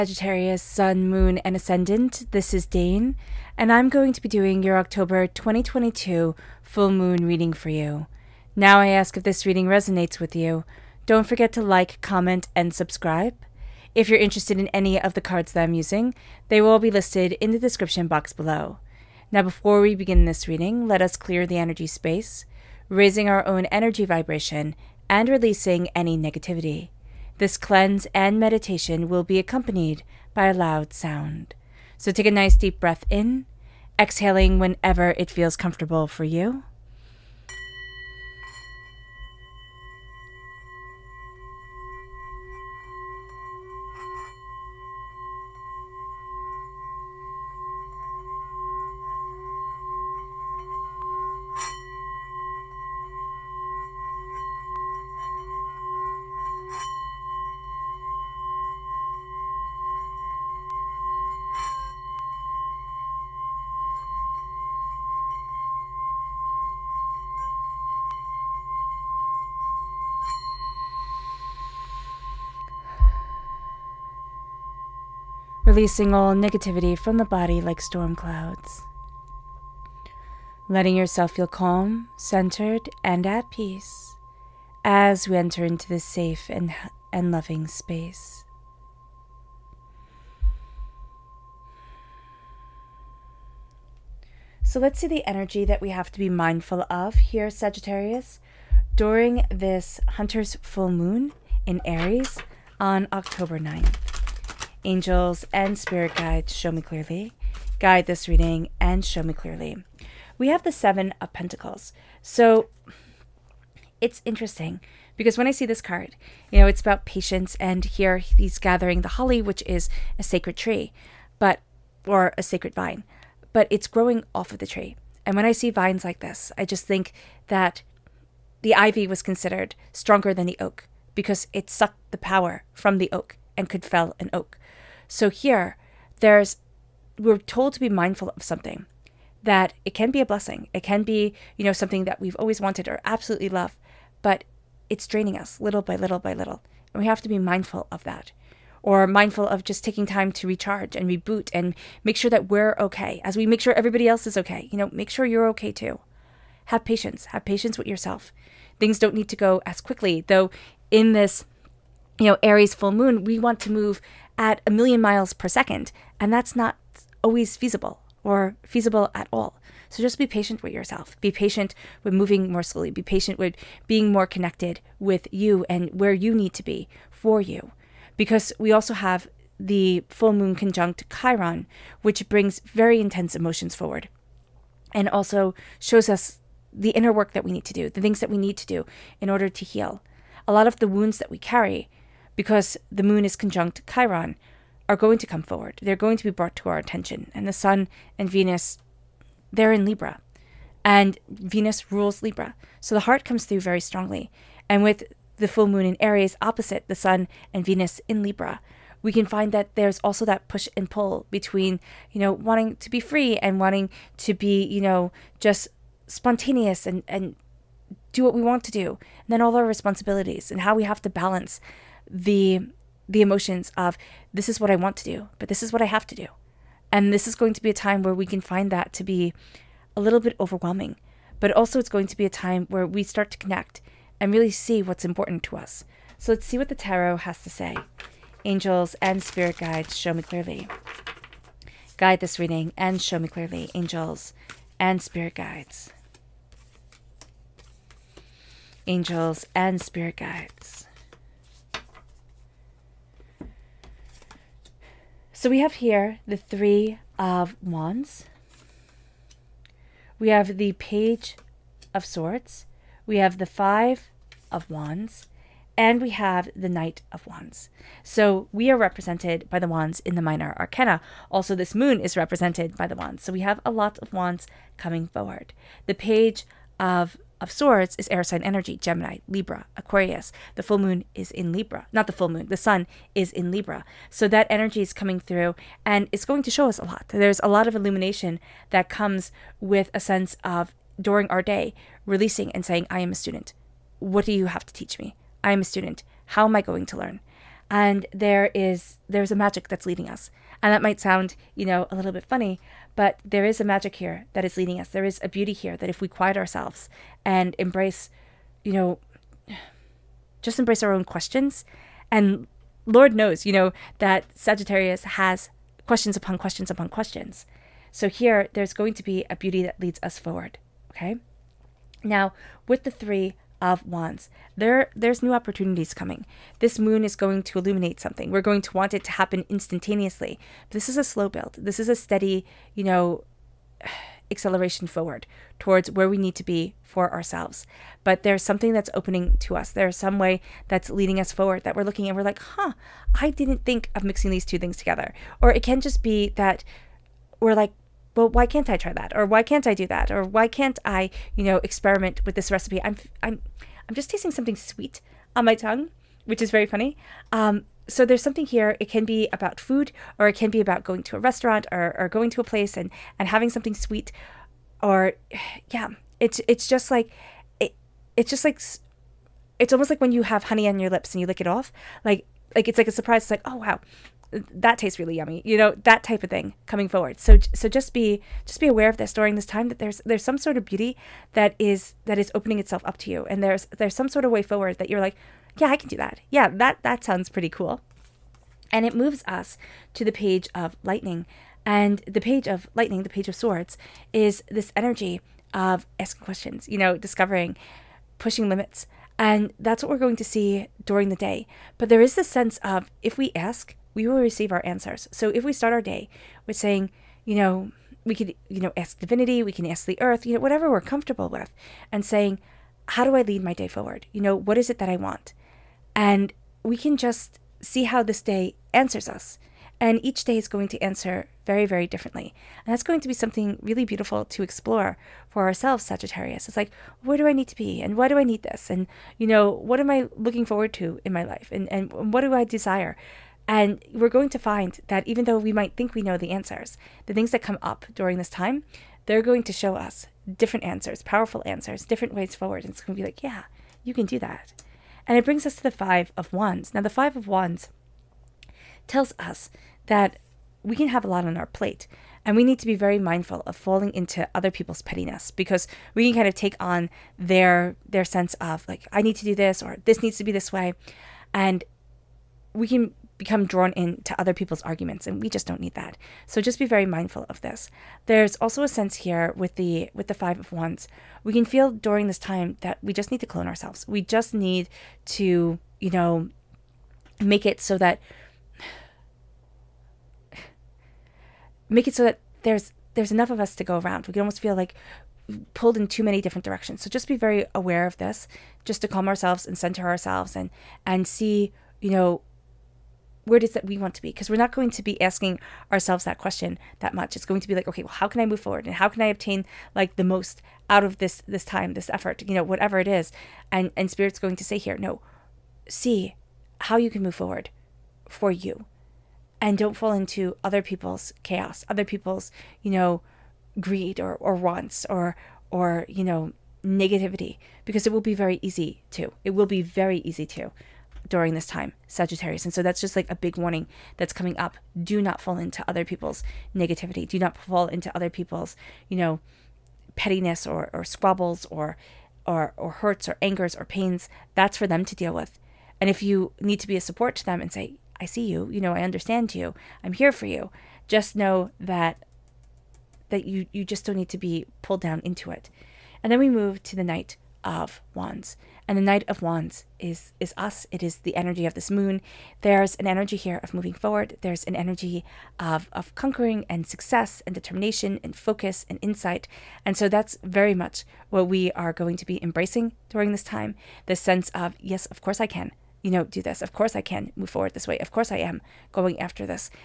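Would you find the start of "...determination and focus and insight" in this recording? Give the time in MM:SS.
09:17.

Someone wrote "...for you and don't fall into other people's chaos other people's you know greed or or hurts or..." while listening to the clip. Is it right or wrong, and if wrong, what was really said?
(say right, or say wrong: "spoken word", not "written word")
wrong: "wants", not "hurts".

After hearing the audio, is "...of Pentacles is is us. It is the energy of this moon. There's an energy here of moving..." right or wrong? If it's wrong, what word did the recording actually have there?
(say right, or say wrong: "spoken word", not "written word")
wrong: "Wands", not "Pentacles".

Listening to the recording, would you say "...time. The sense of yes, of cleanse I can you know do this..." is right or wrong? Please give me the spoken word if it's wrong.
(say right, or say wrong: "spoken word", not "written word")
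wrong: "course", not "cleanse".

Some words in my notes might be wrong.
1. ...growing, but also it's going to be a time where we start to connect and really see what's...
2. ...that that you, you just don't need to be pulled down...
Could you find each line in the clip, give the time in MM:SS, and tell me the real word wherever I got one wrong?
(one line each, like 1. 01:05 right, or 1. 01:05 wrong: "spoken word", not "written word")
1. 03:50 wrong: "overwhelming", not "growing"
2. 09:01 right.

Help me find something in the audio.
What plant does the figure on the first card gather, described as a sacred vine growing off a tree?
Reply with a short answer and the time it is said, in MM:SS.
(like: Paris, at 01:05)
Holly, at 01:59.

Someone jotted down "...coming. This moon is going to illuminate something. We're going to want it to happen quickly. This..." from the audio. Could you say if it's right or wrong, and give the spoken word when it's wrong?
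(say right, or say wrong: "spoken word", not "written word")
wrong: "instantaneously", not "quickly".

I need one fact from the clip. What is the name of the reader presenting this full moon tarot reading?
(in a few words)
Dane.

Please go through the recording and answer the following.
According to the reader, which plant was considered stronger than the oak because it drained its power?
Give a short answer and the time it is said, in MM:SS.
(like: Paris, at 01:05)
Ivy, at 02:08.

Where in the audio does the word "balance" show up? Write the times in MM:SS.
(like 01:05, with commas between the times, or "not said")
03:41.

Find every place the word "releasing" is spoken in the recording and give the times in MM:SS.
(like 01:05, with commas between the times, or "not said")
00:25, 01:15, 04:52.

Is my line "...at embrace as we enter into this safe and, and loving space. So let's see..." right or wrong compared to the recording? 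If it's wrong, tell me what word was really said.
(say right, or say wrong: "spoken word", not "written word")
wrong: "peace", not "embrace".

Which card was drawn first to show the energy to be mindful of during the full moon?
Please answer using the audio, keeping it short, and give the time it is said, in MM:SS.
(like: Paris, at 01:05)
Seven of Pentacles, at 01:50.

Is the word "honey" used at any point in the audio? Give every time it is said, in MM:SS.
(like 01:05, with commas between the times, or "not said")
06:10.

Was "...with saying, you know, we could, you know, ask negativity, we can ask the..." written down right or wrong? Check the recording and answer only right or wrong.
wrong.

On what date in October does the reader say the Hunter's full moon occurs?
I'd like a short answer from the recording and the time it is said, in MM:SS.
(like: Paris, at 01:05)
October 9th, at 01:43.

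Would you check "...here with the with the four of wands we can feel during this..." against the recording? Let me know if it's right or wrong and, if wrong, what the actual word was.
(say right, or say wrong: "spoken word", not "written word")
wrong: "five", not "four".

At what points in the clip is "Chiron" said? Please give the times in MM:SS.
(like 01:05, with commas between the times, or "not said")
03:01, 03:13.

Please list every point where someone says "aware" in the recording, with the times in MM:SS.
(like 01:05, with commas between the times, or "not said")
06:18, 08:07.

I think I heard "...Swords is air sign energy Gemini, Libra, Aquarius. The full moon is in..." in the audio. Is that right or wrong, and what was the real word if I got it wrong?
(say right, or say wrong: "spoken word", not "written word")
right.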